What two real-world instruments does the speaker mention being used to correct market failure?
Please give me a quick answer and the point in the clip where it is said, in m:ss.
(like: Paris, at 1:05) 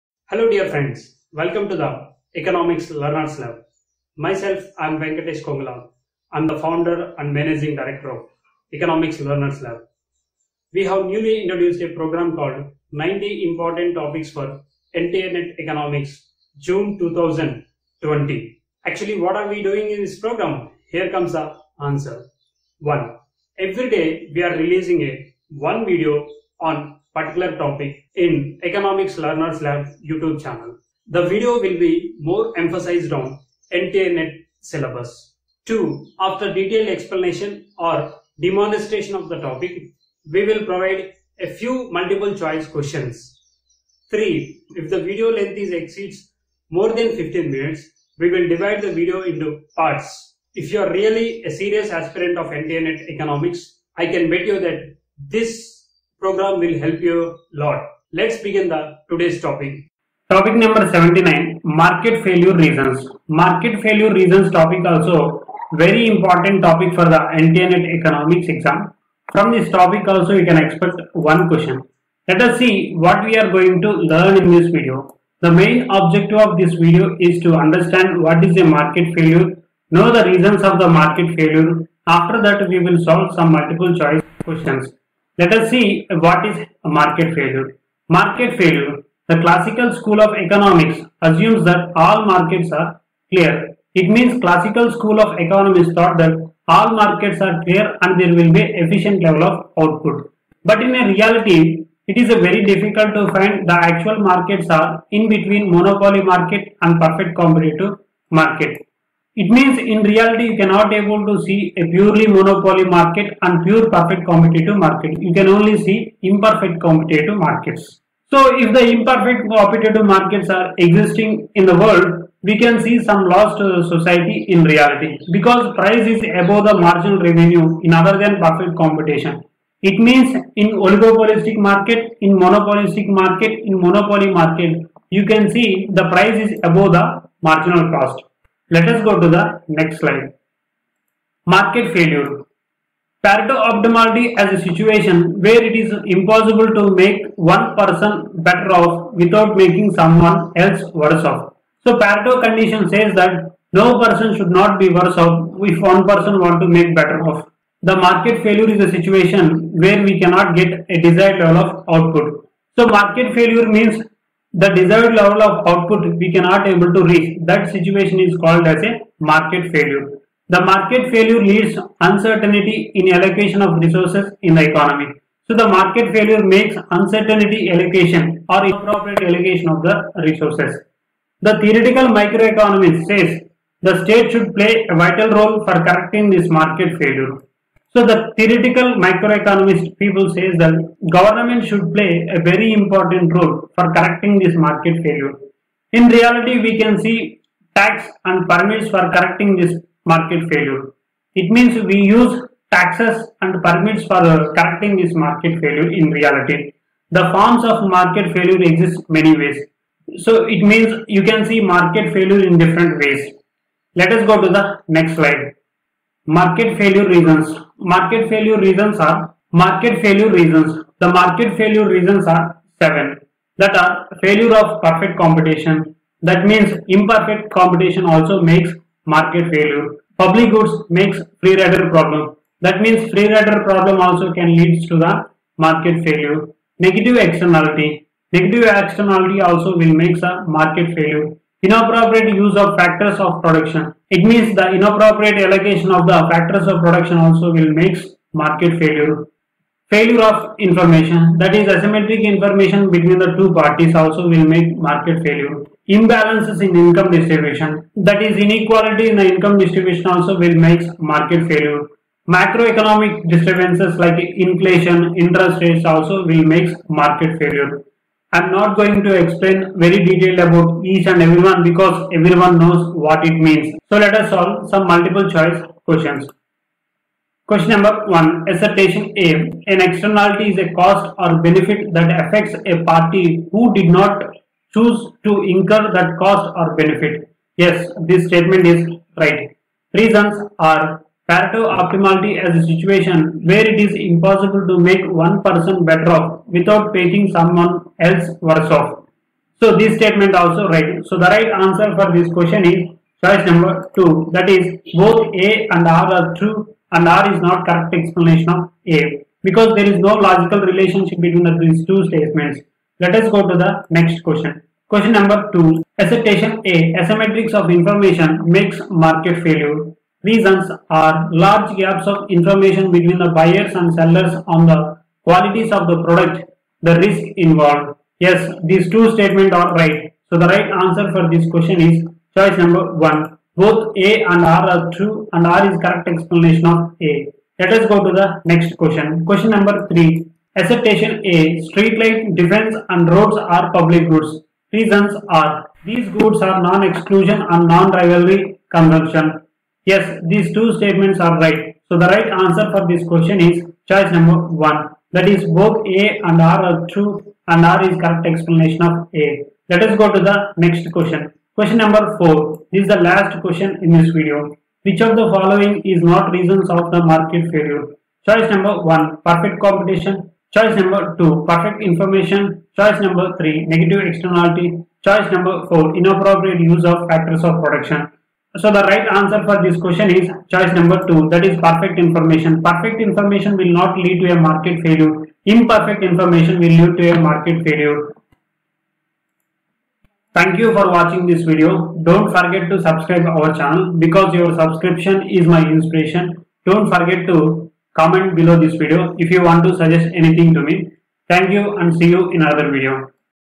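taxes and permits, at 3:17.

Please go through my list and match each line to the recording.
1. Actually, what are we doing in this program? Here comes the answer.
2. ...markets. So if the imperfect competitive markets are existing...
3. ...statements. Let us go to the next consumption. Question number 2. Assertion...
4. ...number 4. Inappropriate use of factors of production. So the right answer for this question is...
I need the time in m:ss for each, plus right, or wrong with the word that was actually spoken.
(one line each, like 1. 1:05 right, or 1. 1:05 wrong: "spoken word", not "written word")
1. 0:18 right
2. 1:57 right
3. 5:12 wrong: "question", not "consumption"
4. 6:15 right.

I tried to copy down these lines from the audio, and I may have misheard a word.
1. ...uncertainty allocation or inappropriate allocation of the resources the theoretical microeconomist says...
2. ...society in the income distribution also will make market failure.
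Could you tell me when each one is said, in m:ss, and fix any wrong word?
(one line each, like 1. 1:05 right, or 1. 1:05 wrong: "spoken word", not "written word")
1. 2:56 right
2. 4:18 wrong: "inequality", not "society".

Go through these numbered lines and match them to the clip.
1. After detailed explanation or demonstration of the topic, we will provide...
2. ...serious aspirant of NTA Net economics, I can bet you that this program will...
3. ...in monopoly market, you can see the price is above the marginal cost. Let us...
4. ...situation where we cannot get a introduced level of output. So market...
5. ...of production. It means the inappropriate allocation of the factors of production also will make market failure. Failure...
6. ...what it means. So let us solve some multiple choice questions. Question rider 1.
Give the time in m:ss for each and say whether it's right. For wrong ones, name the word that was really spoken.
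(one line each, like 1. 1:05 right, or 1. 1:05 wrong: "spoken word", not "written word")
1. 0:36 right
2. 0:51 right
3. 2:13 right
4. 2:38 wrong: "desired", not "introduced"
5. 4:03 right
6. 4:32 wrong: "number", not "rider".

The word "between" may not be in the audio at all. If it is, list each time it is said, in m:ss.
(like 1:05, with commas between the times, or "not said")
1:45, 4:12, 5:11, 5:22.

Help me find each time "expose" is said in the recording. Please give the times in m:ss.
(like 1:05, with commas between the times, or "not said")
not said.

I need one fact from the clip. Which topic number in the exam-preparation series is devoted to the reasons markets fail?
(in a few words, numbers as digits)
79.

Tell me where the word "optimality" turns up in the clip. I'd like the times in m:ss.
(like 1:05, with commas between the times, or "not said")
2:23, 4:51.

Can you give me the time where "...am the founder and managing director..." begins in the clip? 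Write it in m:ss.
0:06.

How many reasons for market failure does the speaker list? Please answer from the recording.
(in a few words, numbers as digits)
7.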